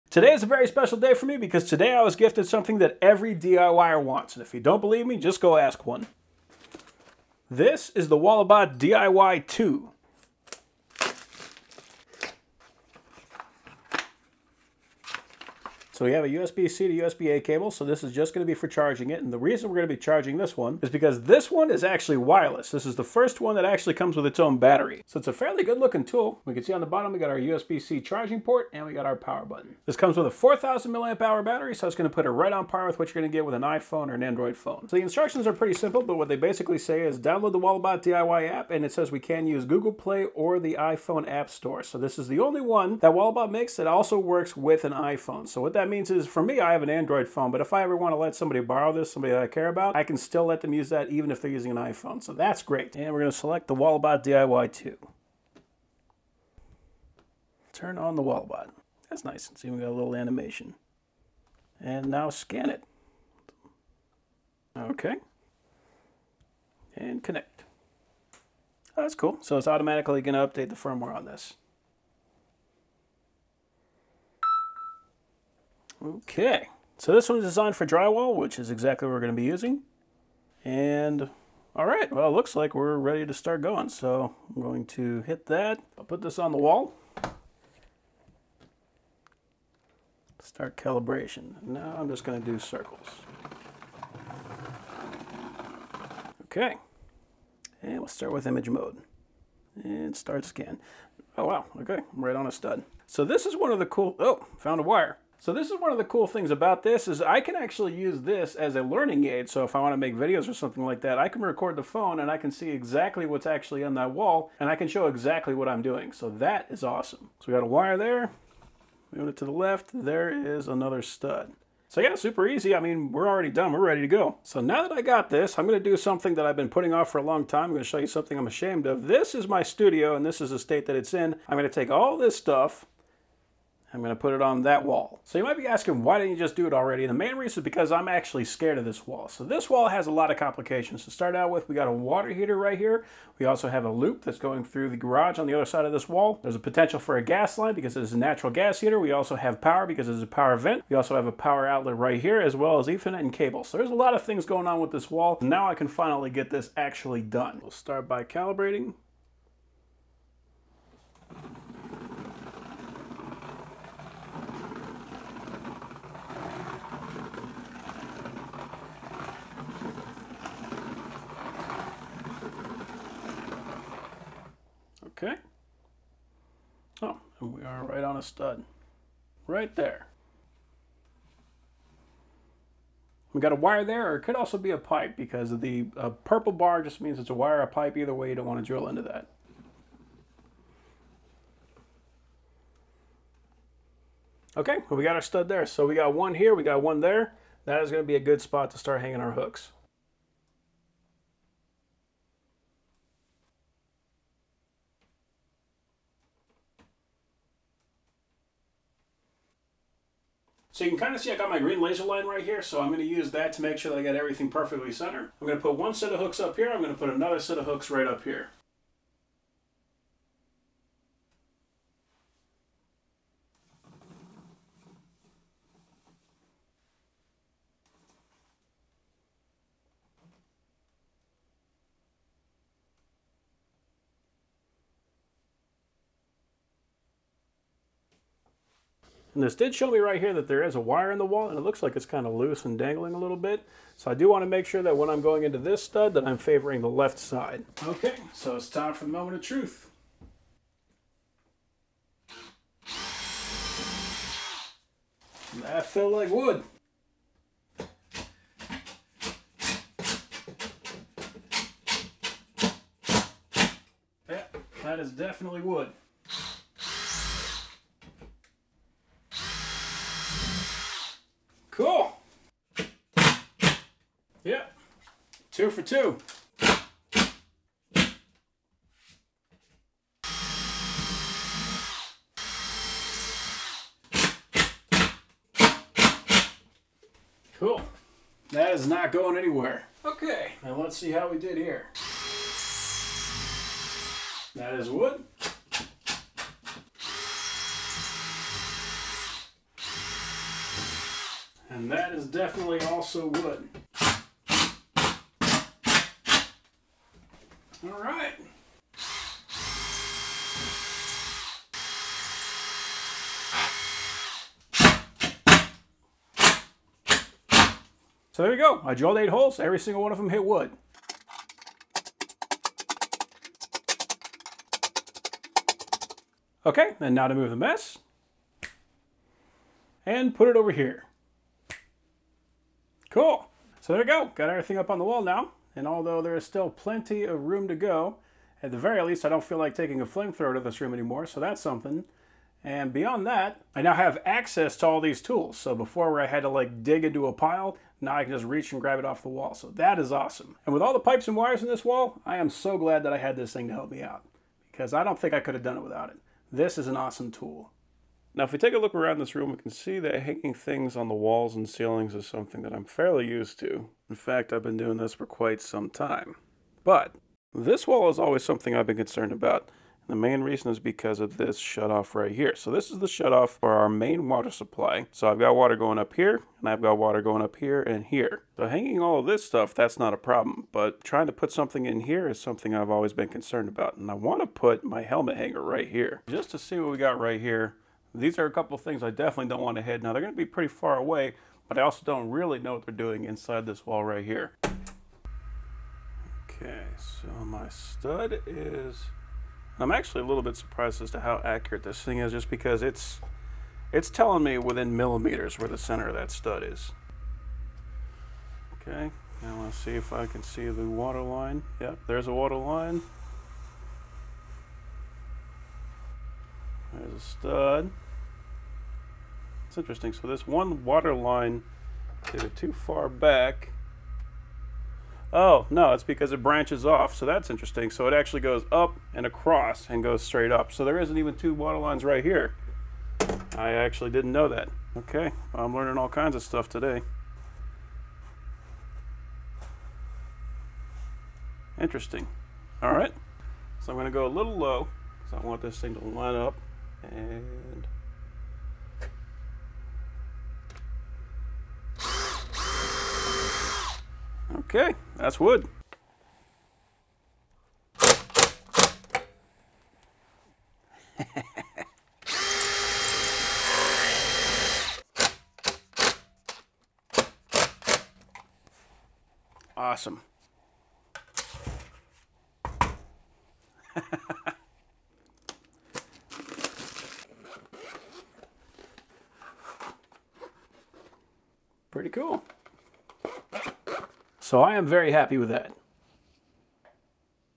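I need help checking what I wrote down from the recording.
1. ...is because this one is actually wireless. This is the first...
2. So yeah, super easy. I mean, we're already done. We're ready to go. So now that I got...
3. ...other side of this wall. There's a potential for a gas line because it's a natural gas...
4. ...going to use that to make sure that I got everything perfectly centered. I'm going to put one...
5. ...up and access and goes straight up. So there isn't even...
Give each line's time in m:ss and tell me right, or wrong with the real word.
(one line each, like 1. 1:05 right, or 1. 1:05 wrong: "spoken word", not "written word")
1. 0:20 right
2. 2:01 right
3. 2:25 right
4. 3:32 right
5. 7:08 wrong: "across", not "access".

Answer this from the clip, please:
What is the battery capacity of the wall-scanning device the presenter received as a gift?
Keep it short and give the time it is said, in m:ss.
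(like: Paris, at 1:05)
4,000 mAh, at 0:30.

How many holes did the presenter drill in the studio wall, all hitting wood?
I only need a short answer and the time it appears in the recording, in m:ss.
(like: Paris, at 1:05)
8, at 5:19.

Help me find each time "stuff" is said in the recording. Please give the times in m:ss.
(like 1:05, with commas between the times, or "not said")
2:12, 6:19, 7:16.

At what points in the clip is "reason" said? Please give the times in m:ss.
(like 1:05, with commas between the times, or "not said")
0:19, 2:17, 6:10.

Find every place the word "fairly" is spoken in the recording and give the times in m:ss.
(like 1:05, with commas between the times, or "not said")
0:25, 6:02.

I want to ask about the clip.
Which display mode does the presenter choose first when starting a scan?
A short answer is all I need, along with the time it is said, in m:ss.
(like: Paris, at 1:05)
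Image mode, at 1:38.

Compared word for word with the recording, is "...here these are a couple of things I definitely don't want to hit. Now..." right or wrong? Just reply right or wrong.
right.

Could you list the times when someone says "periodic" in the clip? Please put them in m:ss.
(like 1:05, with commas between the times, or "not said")
not said.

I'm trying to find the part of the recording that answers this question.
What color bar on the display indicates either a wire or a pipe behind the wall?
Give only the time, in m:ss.
3:06.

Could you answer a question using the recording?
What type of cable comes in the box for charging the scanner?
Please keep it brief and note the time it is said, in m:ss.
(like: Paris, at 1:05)
USB-C to USB-A, at 0:16.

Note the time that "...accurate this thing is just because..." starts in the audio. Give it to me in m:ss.
6:41.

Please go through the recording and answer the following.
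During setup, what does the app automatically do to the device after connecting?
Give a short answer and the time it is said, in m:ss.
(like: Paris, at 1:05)
Update the firmware, at 1:10.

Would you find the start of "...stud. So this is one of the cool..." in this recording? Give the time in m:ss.
1:42.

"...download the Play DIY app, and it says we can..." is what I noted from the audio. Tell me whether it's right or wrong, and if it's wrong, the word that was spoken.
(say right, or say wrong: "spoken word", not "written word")
wrong: "Walabot", not "Play".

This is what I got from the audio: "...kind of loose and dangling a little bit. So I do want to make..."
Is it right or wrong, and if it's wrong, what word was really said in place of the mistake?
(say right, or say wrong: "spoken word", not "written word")
right.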